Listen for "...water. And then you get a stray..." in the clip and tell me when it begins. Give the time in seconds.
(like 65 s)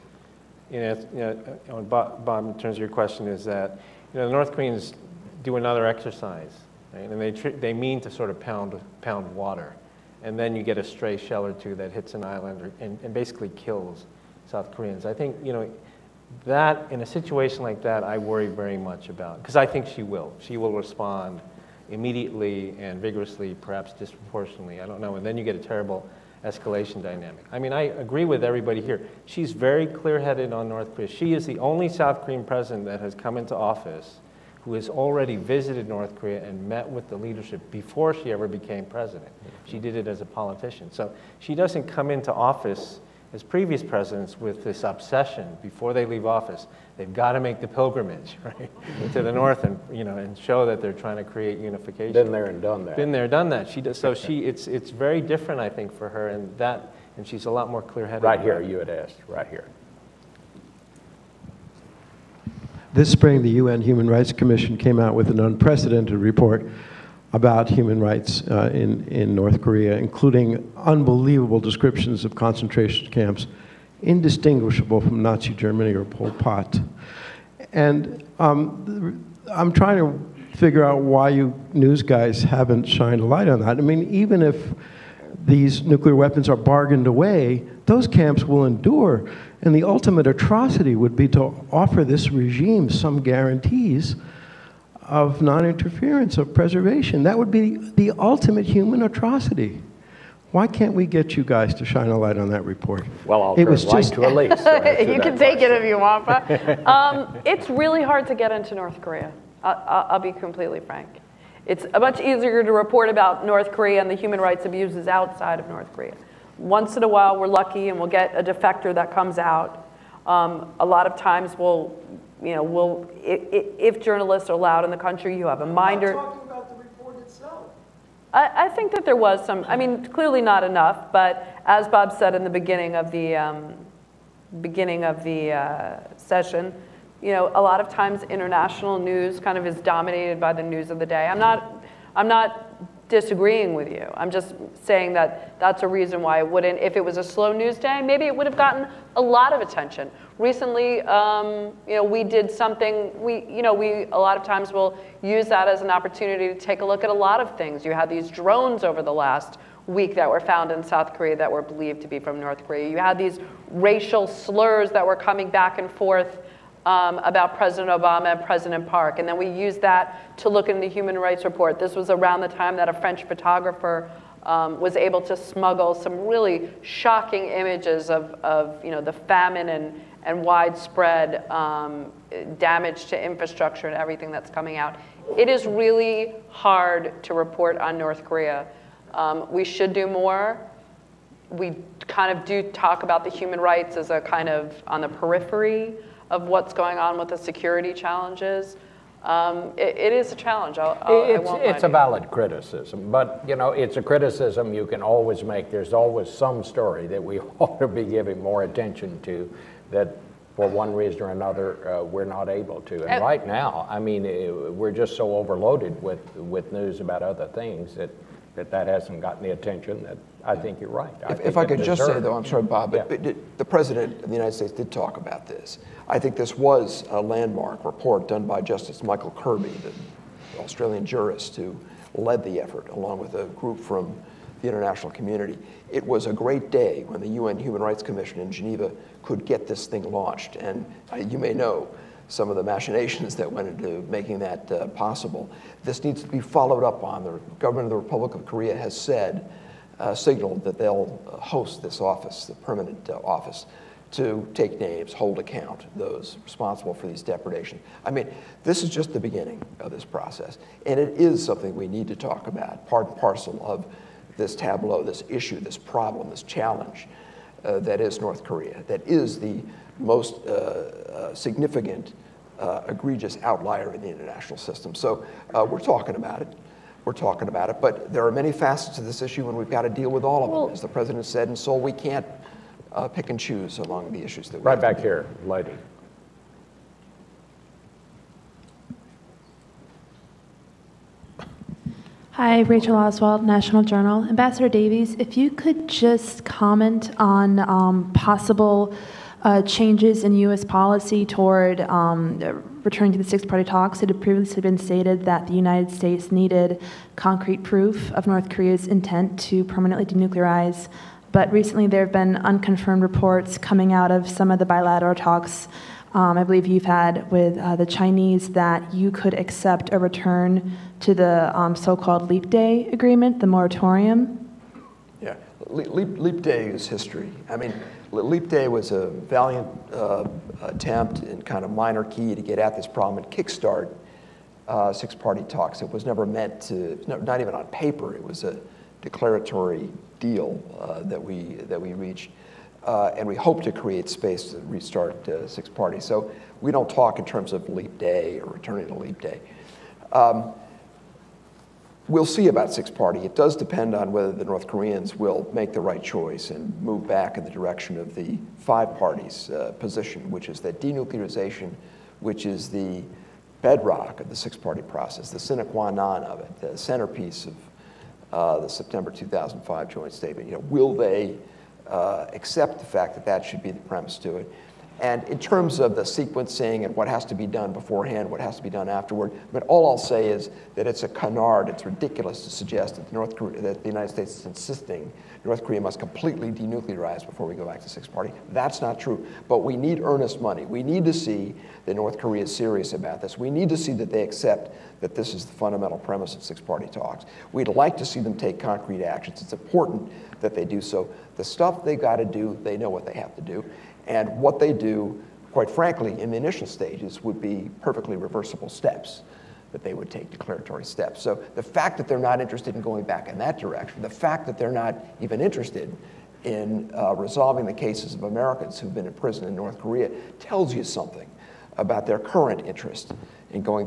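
9 s.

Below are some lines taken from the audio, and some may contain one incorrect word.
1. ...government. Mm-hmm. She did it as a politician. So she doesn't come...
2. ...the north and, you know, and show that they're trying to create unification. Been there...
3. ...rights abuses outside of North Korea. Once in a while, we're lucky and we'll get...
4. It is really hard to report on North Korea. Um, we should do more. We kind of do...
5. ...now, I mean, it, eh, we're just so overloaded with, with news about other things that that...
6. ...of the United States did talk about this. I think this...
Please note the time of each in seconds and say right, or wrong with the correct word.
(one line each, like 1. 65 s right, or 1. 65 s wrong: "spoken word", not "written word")
1. 38 s wrong: "president", not "government"
2. 49 s right
3. 114 s right
4. 185 s right
5. 213 s right
6. 224 s right.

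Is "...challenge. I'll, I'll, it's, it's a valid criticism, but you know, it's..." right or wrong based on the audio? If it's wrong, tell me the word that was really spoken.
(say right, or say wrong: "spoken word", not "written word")
right.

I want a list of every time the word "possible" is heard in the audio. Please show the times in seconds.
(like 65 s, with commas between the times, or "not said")
244 s, 298 s.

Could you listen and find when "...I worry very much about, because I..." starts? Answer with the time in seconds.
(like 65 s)
18 s.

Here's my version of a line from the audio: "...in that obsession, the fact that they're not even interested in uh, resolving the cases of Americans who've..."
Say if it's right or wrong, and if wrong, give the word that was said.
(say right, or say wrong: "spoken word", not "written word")
wrong: "direction", not "obsession".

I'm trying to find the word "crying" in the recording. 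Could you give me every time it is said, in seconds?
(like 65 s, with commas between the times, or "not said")
not said.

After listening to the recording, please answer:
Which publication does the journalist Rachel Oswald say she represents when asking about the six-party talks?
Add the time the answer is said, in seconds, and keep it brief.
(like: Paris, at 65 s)
National Journal, at 293 s.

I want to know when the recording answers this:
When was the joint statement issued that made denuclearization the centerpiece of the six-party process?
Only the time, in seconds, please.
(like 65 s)
368 s.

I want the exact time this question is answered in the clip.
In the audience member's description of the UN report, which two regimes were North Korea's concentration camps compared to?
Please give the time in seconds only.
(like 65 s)
75 s.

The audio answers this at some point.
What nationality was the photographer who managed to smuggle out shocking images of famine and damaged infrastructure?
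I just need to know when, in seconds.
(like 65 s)
172 s.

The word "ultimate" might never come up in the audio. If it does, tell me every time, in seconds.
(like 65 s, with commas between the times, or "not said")
89 s, 98 s.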